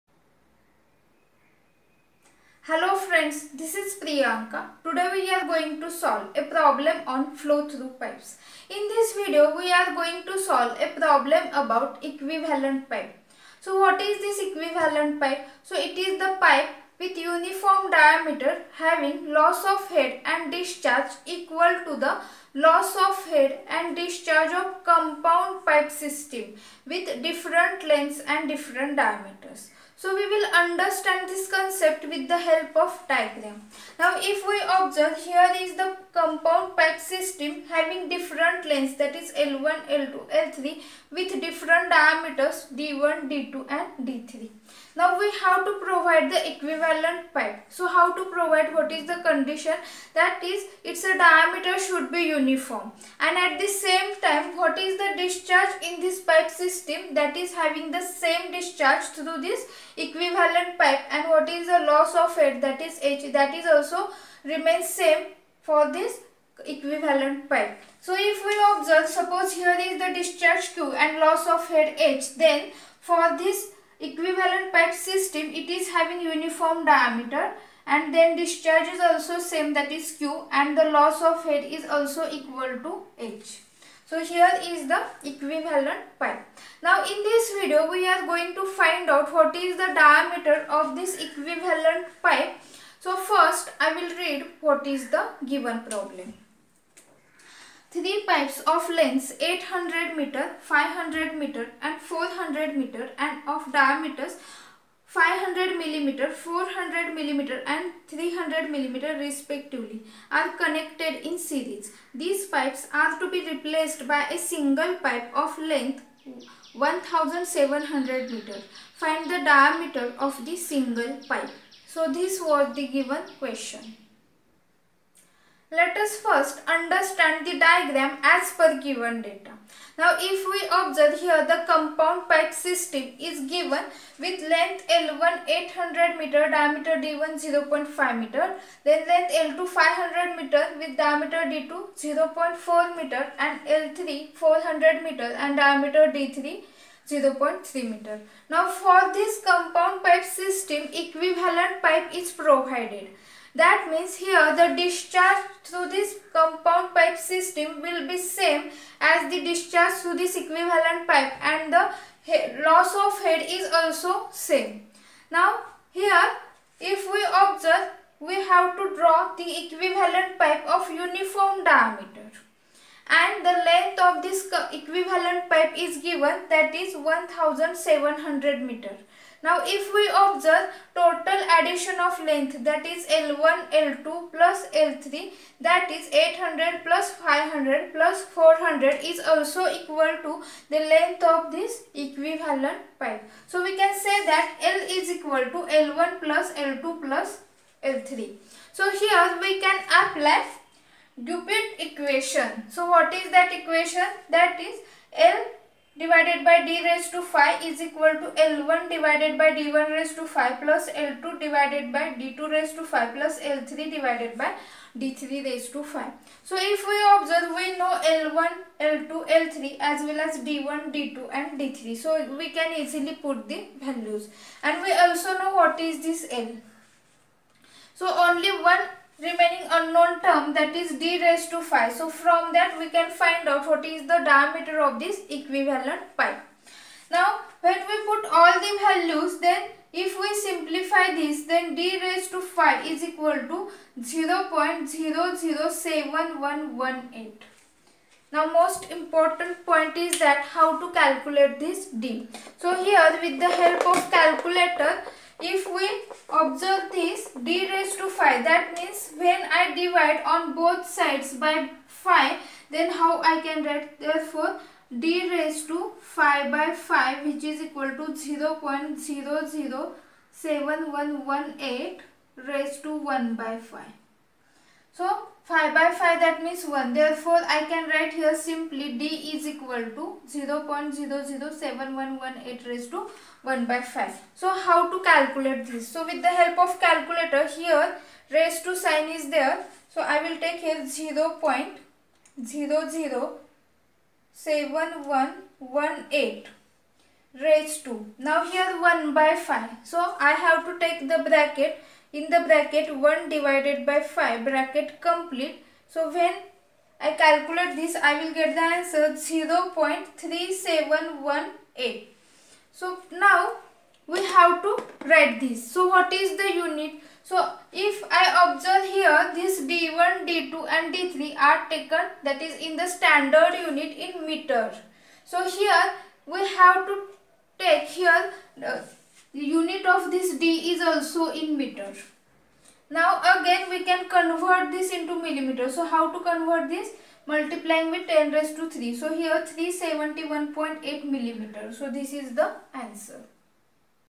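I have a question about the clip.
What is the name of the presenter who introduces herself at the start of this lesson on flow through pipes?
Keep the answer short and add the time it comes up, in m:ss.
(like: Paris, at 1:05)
Priyanka, at 0:04.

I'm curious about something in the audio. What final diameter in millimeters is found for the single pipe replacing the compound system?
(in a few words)
371.8 millimeter.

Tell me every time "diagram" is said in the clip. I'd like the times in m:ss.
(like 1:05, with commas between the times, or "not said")
0:33, 2:07.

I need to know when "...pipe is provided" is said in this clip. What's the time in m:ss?
2:31.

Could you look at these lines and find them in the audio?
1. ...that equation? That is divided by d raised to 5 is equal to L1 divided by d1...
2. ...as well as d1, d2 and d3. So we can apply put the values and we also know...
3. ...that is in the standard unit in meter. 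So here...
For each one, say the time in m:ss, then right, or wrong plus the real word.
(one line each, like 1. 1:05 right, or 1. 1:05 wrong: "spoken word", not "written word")
1. 3:23 right
2. 3:39 wrong: "easily", not "apply"
3. 5:22 right.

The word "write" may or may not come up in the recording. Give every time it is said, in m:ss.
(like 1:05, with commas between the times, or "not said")
4:23, 4:37, 5:15.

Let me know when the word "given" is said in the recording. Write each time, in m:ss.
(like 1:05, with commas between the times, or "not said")
1:35, 2:02, 2:08, 2:13, 2:55.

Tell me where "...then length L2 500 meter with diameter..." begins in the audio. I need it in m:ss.
2:18.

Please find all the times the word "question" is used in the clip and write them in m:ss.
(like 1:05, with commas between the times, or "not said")
2:03.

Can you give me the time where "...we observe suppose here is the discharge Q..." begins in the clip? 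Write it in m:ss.
1:08.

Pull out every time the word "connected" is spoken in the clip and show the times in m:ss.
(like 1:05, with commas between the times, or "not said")
1:50.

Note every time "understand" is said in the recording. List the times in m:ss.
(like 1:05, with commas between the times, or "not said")
0:30, 2:06.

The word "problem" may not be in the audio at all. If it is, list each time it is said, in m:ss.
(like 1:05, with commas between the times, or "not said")
0:06, 0:10, 1:35.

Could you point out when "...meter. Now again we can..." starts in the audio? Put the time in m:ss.
5:31.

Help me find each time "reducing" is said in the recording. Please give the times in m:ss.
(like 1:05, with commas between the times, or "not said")
not said.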